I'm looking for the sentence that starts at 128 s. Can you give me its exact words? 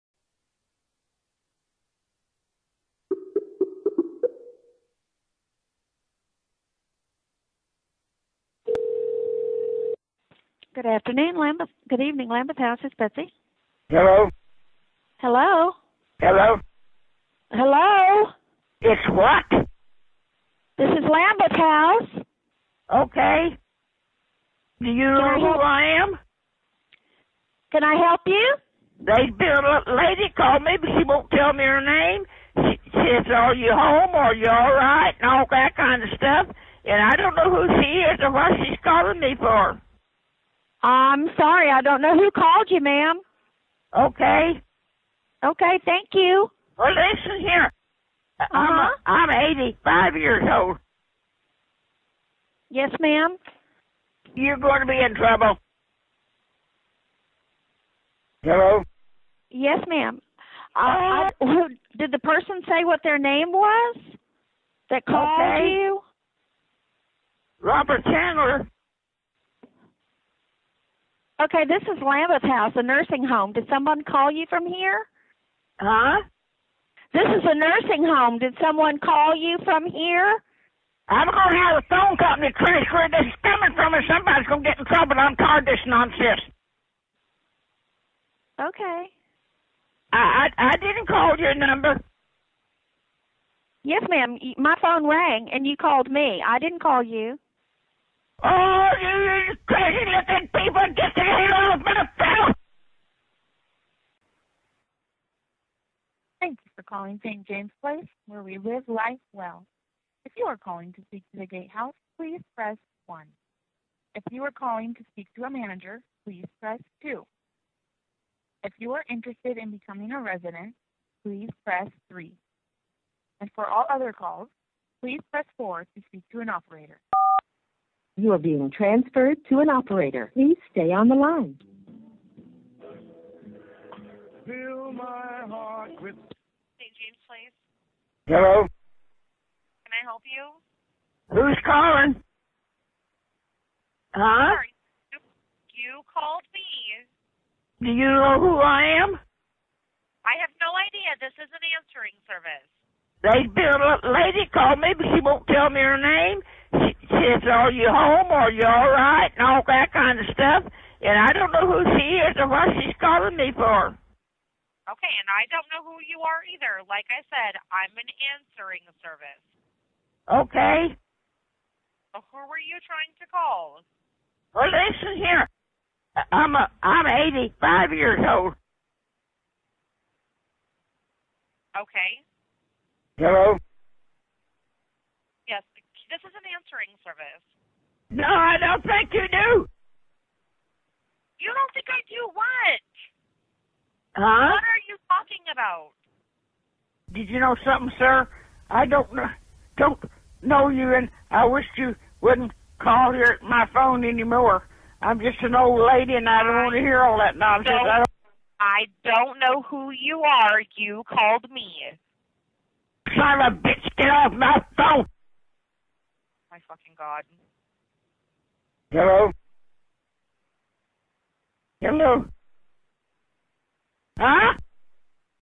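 You are being transferred to an operator.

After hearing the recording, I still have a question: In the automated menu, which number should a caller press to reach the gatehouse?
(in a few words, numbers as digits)
1.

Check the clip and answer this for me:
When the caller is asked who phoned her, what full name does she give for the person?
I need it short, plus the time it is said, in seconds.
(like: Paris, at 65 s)
Robert Chandler, at 67 s.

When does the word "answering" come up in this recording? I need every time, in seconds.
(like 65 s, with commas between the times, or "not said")
151 s, 168 s, 186 s.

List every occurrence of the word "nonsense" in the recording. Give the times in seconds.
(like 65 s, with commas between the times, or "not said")
85 s, 207 s.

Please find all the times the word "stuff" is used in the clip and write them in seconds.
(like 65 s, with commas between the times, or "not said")
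36 s, 160 s.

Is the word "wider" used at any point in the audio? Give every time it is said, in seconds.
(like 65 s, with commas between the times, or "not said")
not said.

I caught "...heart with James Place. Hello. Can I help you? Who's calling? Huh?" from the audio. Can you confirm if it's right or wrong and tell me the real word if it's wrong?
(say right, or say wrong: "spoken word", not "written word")
right.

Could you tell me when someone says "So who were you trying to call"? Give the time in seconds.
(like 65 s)
172 s.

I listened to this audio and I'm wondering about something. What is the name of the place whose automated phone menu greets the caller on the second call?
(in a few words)
St. James Place.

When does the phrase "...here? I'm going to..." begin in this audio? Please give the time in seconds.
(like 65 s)
79 s.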